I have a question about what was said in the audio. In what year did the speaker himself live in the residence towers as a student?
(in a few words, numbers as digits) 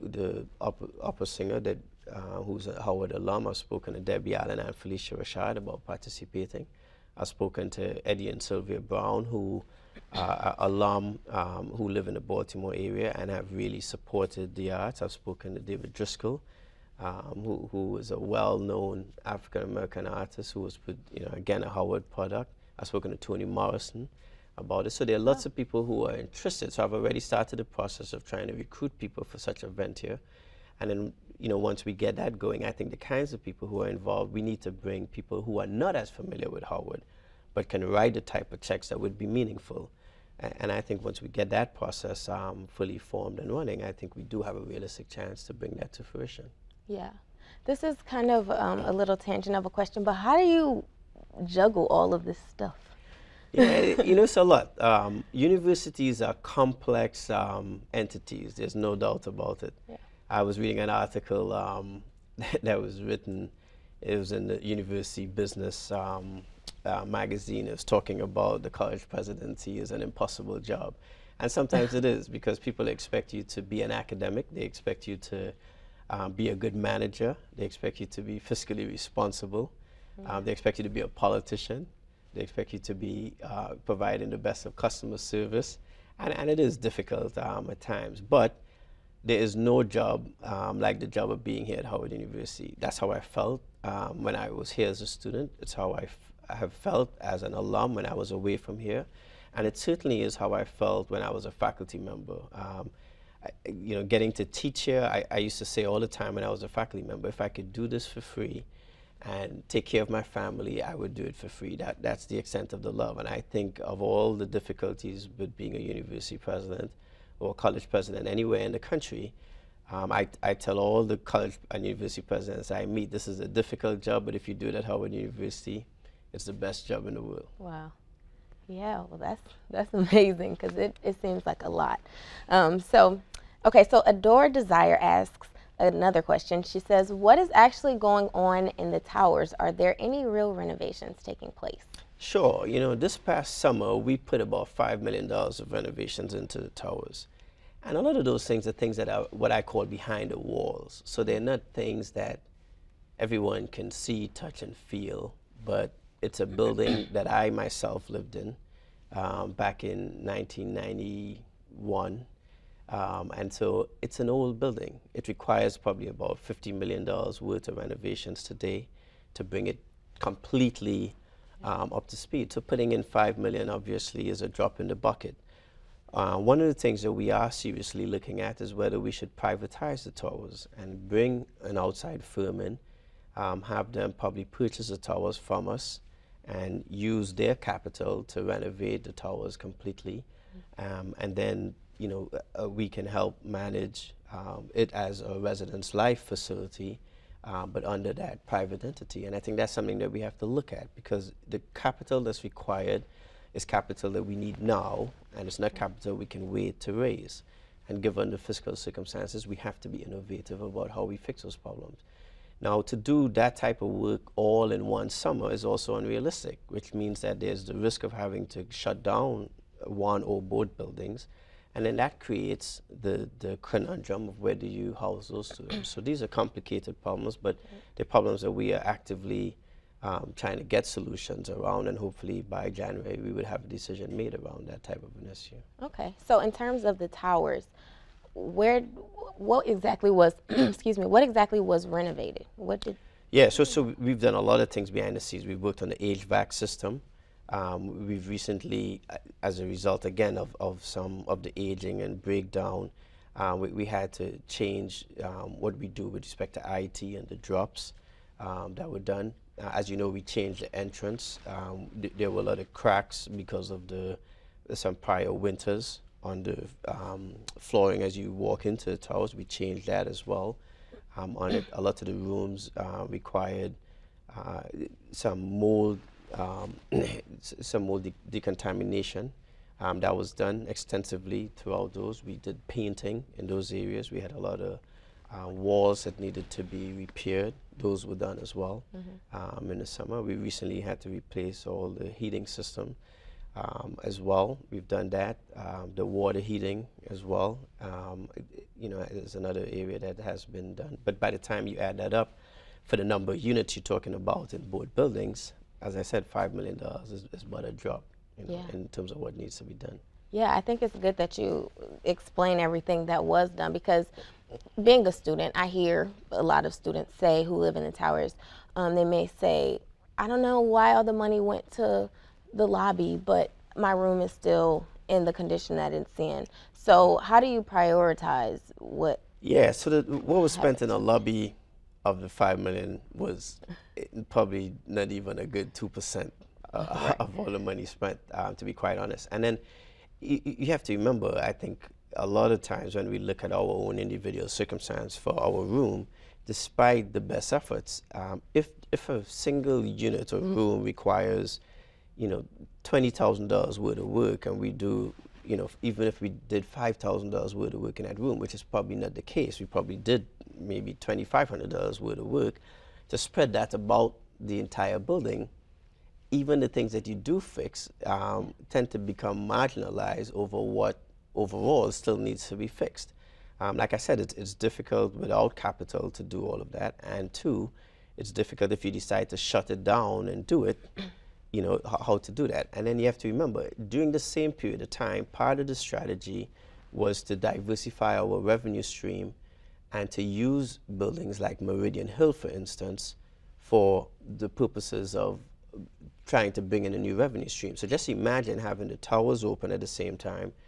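1991.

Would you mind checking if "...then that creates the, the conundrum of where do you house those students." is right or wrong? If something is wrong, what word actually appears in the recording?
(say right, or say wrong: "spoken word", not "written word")
right.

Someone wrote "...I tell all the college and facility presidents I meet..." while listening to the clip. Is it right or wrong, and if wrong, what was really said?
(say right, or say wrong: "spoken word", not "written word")
wrong: "university", not "facility".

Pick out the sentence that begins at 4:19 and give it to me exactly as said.
Uh, as you know, we changed the entrance.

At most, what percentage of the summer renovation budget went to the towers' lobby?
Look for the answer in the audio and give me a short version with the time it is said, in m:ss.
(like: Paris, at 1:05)
2 percent, at 5:35.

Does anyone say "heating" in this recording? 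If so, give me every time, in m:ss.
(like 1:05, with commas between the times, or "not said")
4:52, 4:56.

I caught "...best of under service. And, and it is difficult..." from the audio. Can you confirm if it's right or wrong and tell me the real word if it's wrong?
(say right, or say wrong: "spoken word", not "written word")
wrong: "customer", not "under".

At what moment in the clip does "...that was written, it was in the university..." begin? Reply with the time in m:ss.
1:02.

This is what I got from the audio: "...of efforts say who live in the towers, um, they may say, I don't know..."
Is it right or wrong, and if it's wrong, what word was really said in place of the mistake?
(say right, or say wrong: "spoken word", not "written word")
wrong: "students", not "efforts".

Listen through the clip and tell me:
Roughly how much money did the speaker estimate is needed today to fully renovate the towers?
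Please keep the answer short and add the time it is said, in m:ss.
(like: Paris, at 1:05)
$50 million, at 2:46.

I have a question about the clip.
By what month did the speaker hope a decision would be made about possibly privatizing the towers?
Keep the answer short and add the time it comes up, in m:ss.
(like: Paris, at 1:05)
January, at 3:52.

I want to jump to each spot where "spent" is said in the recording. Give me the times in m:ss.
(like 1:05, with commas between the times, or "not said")
5:30, 5:37.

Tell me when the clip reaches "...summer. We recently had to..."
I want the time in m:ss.
4:49.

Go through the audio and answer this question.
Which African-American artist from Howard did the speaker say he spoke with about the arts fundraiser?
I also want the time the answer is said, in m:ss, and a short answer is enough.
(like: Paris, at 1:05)
David Driskell, at 0:15.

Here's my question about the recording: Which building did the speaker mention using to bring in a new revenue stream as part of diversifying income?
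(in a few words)
Meridian Hill.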